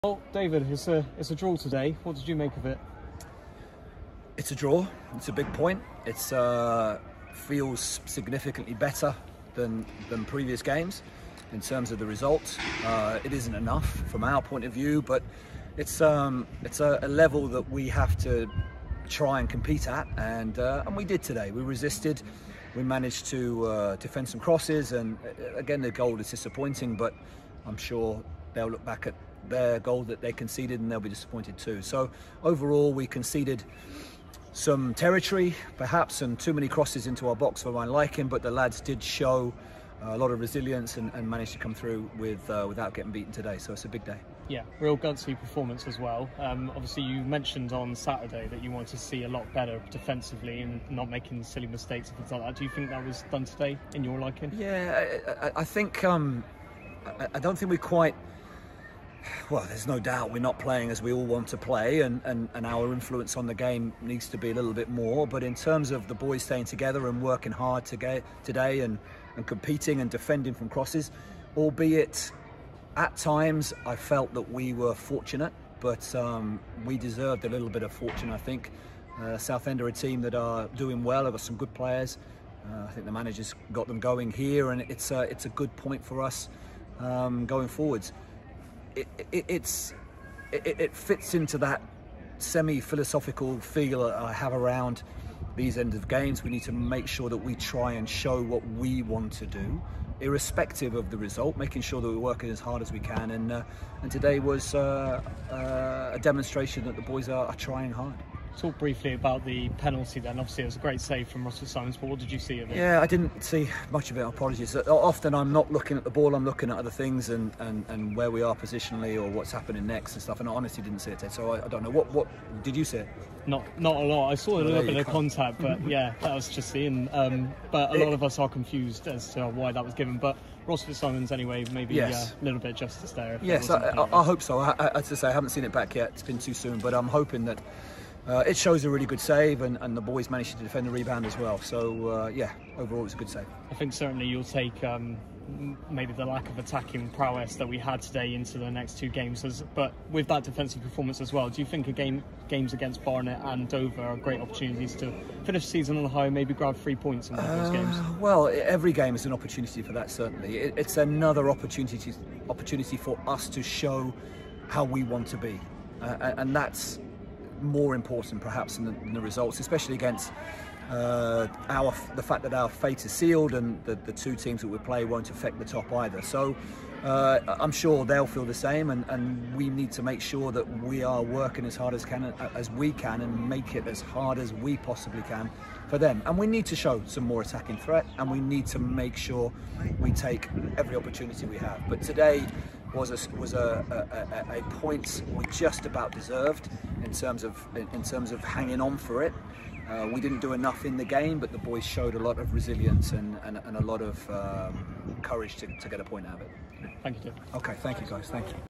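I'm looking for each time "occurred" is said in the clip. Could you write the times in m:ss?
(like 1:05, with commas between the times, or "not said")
not said.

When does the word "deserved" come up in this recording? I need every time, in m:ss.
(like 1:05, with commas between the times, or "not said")
1:16, 3:16.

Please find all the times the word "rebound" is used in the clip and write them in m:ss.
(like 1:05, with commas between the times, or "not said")
2:20.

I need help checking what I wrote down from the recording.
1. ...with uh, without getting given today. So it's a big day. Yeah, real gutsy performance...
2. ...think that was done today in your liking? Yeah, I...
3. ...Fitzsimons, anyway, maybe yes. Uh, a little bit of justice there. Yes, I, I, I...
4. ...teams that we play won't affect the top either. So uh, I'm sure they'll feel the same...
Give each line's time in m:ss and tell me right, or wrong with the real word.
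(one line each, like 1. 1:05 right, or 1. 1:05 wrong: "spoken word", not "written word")
1. 0:42 wrong: "beaten", not "given"
2. 0:52 right
3. 2:10 right
4. 2:54 right.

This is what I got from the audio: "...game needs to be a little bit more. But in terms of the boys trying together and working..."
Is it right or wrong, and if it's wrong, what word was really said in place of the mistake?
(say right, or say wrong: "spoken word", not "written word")
wrong: "staying", not "trying".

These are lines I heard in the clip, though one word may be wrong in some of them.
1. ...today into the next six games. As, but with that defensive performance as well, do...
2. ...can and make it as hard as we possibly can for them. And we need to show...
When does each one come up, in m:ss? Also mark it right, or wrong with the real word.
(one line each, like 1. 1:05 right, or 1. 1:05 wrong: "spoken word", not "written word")
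1. 2:28 wrong: "two", not "six"
2. 3:02 right.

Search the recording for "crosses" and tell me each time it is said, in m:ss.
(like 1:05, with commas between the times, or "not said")
0:24, 0:36, 1:10.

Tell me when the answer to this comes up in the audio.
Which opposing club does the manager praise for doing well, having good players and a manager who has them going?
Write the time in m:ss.
1:19.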